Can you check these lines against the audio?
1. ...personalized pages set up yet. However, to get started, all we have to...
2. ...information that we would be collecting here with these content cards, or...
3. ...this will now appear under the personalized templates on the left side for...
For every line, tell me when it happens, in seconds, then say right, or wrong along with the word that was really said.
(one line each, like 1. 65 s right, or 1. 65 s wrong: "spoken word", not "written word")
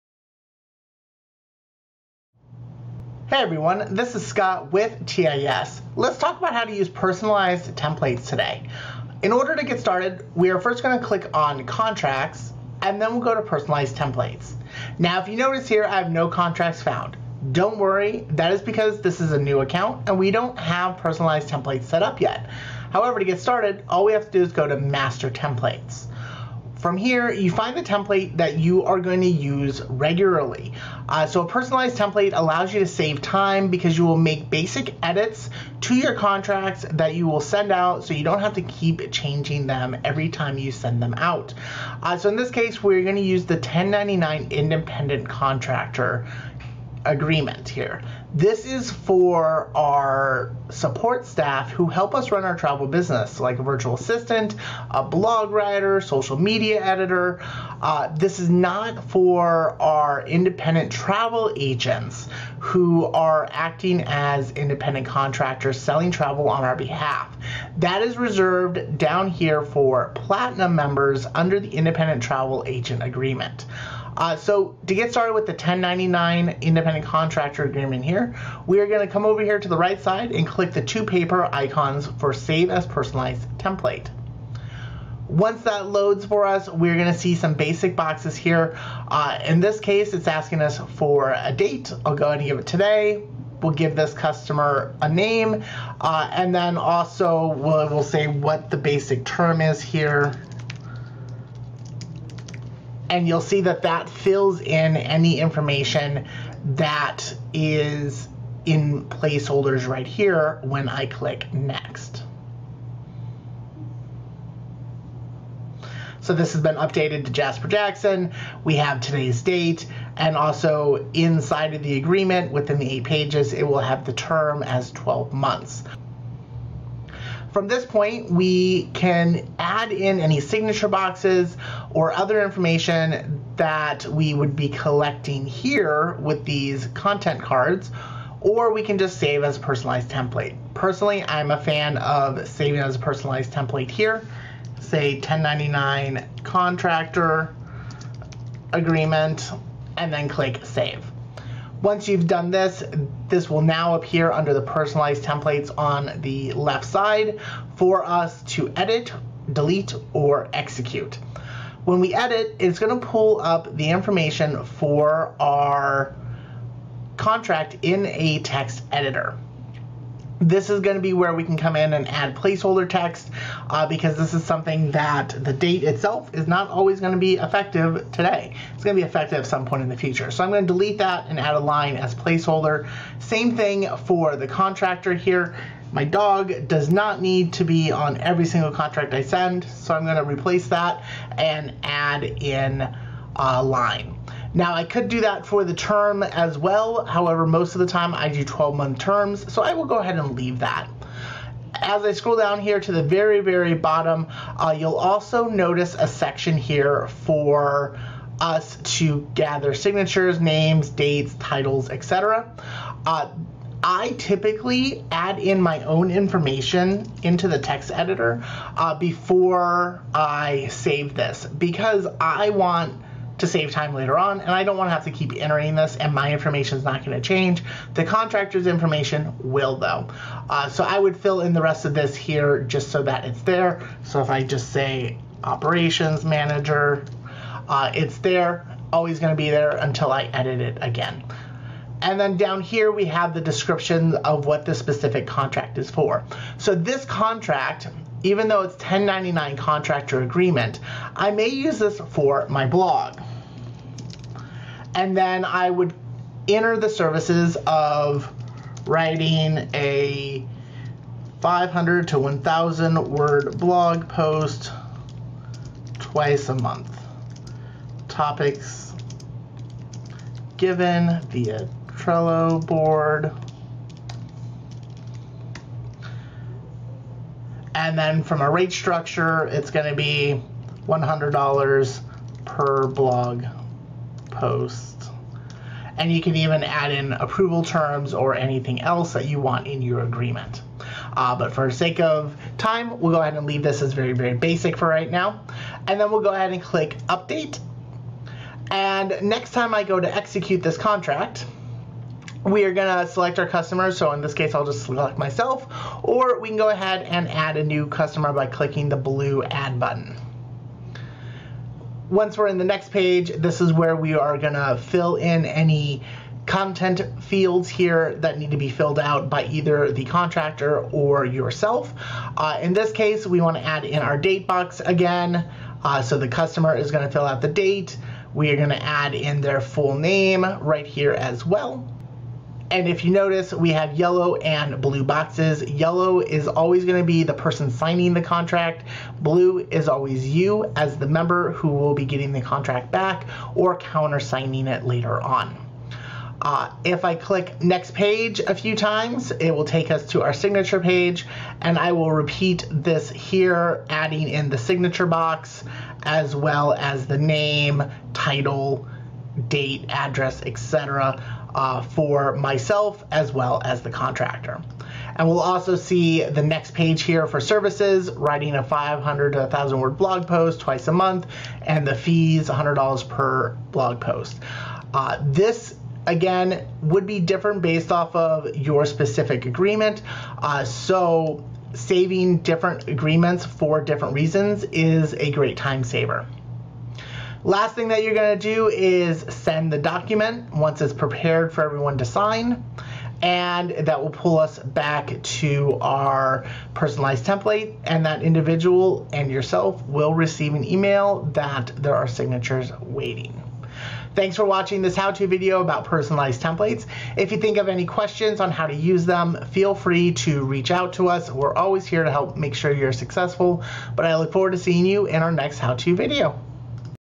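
1. 20 s wrong: "templates", not "pages"
2. 132 s right
3. 153 s right.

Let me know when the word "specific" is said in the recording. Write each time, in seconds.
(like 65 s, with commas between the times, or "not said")
244 s, 378 s.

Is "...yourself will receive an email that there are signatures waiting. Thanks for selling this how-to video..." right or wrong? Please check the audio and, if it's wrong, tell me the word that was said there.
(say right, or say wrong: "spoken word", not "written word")
wrong: "watching", not "selling".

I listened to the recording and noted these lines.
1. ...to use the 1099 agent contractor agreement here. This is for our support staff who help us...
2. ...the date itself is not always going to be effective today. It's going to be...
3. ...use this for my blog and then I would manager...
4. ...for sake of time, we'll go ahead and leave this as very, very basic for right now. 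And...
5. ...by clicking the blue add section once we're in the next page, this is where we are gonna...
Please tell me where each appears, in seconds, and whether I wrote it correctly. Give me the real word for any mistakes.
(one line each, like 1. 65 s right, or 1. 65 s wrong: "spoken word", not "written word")
1. 43 s wrong: "independent", not "agent"
2. 175 s right
3. 251 s wrong: "enter", not "manager"
4. 291 s right
5. 308 s wrong: "button", not "section".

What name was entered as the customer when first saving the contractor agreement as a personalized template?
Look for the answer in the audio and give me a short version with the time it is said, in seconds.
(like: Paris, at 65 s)
Jasper Jackson, at 117 s.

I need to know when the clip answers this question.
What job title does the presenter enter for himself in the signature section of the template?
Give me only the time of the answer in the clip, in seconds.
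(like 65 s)
235 s.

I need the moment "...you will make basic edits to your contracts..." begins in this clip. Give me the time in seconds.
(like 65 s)
33 s.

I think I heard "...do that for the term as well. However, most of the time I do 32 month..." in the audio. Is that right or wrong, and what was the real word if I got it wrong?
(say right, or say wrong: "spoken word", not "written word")
wrong: "12", not "32".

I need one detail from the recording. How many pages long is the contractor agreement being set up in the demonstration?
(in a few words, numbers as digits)
8.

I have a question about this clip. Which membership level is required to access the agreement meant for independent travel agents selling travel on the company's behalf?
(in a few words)
Platinum.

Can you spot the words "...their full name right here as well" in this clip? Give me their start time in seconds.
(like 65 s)
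329 s.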